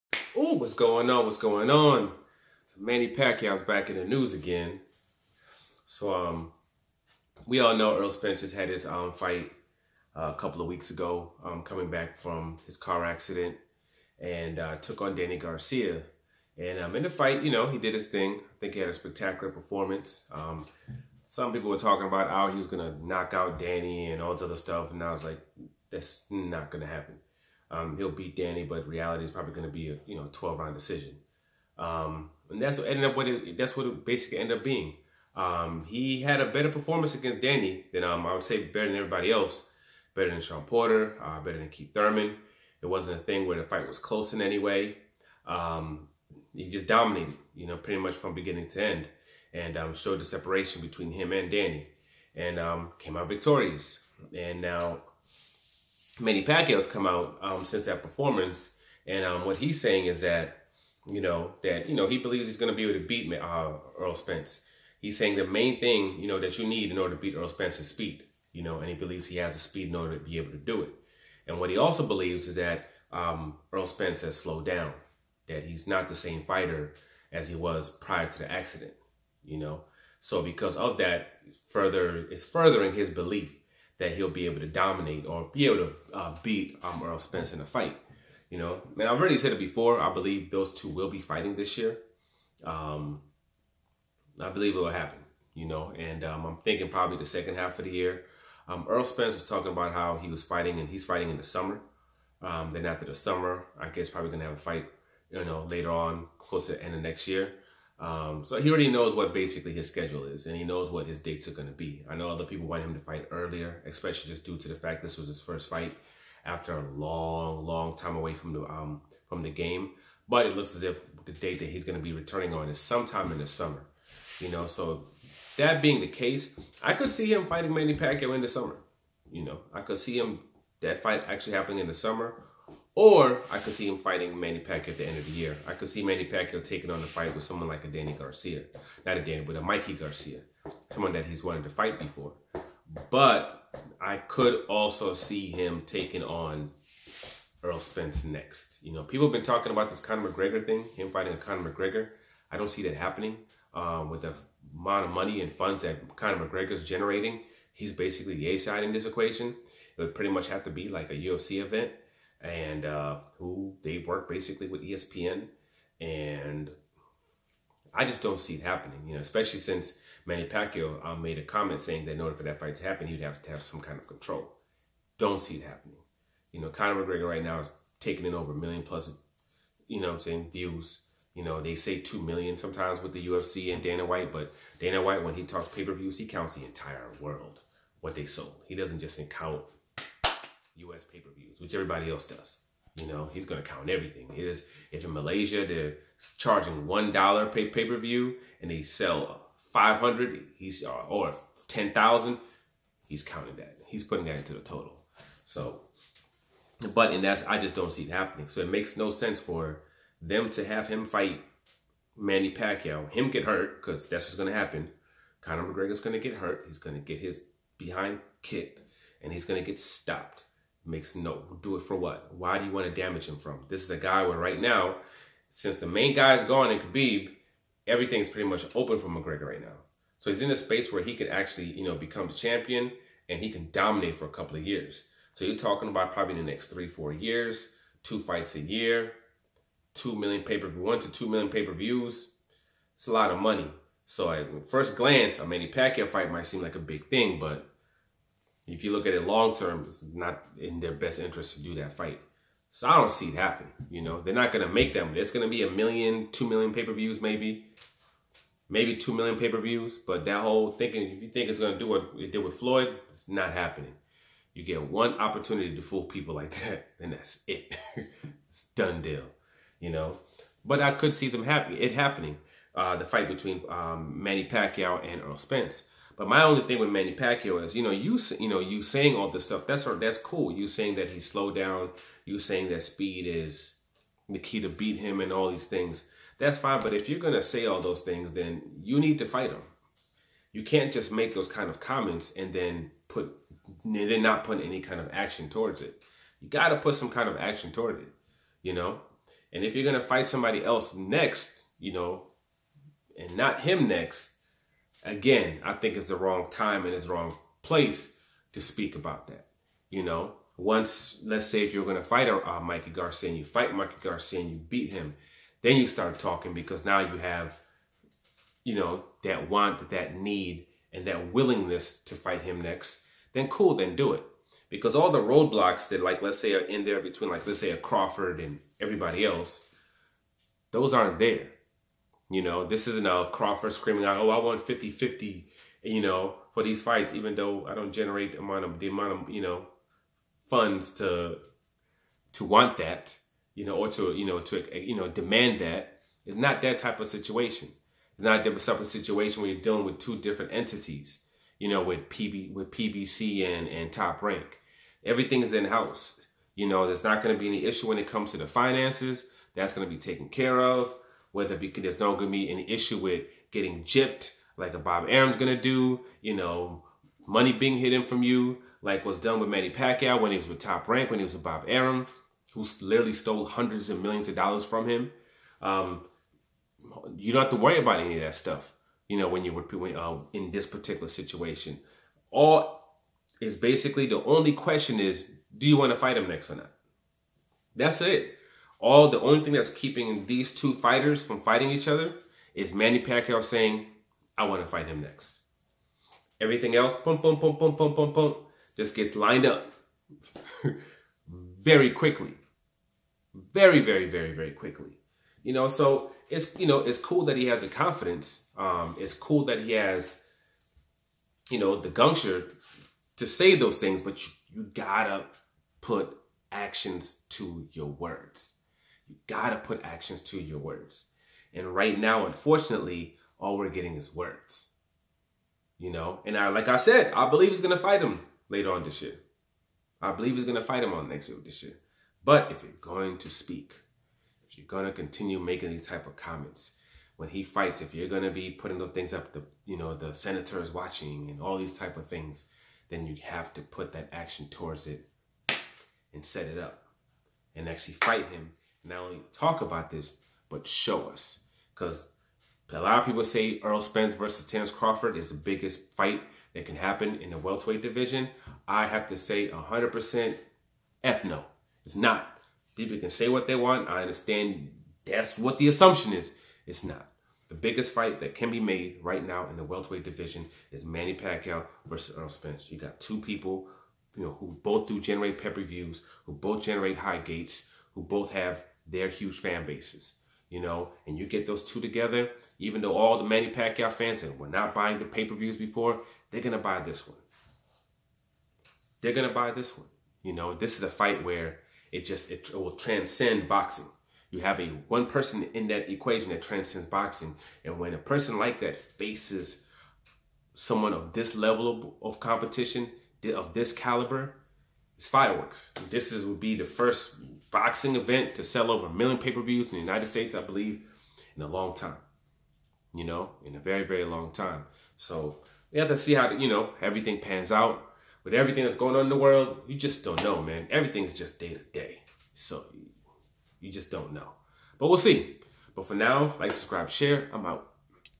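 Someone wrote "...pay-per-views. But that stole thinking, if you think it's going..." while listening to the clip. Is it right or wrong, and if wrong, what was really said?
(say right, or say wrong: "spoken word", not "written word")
wrong: "whole", not "stole".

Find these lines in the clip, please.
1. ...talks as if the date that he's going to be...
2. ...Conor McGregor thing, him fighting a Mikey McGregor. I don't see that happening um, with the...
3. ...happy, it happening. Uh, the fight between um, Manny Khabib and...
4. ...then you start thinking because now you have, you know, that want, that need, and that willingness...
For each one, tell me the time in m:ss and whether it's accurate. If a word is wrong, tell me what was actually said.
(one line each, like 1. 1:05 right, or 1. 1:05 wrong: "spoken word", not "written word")
1. 2:00 wrong: "looks", not "talks"
2. 2:30 wrong: "Conor", not "Mikey"
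3. 4:31 wrong: "Pacquiao", not "Khabib"
4. 5:15 wrong: "talking", not "thinking".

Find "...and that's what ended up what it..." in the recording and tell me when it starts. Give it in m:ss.
0:32.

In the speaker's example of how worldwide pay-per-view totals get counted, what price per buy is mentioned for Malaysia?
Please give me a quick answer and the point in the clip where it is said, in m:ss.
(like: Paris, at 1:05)
$1, at 3:16.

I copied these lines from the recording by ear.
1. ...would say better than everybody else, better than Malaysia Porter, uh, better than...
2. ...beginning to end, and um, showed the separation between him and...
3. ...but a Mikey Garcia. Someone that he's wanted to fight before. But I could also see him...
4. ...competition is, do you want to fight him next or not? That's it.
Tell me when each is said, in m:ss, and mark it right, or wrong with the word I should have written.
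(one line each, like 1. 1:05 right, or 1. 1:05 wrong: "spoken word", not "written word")
1. 0:38 wrong: "Shawn", not "Malaysia"
2. 0:48 right
3. 2:19 right
4. 6:24 wrong: "question", not "competition".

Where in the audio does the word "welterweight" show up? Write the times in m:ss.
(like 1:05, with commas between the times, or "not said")
7:37, 7:49.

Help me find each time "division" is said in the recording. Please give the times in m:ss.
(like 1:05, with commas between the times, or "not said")
7:37, 7:50.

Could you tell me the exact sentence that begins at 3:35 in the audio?
Conor McGregor's going to get hurt.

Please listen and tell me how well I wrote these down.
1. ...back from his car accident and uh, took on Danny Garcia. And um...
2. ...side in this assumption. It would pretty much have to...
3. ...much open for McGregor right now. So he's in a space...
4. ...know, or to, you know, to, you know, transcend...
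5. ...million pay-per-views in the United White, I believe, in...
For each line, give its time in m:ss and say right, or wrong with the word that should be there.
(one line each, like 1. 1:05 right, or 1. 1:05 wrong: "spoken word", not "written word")
1. 0:11 right
2. 2:38 wrong: "equation", not "assumption"
3. 3:48 right
4. 5:43 wrong: "demand", not "transcend"
5. 8:28 wrong: "States", not "White".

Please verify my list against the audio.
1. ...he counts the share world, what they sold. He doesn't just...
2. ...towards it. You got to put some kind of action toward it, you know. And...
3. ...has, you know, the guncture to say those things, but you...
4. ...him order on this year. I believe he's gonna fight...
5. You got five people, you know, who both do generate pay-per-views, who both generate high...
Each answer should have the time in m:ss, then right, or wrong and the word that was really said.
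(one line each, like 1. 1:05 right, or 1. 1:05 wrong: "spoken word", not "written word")
1. 3:06 wrong: "entire", not "share"
2. 4:55 right
3. 6:49 right
4. 7:08 wrong: "later", not "order"
5. 7:52 wrong: "two", not "five".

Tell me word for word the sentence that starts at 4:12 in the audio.
So I don't see it happen.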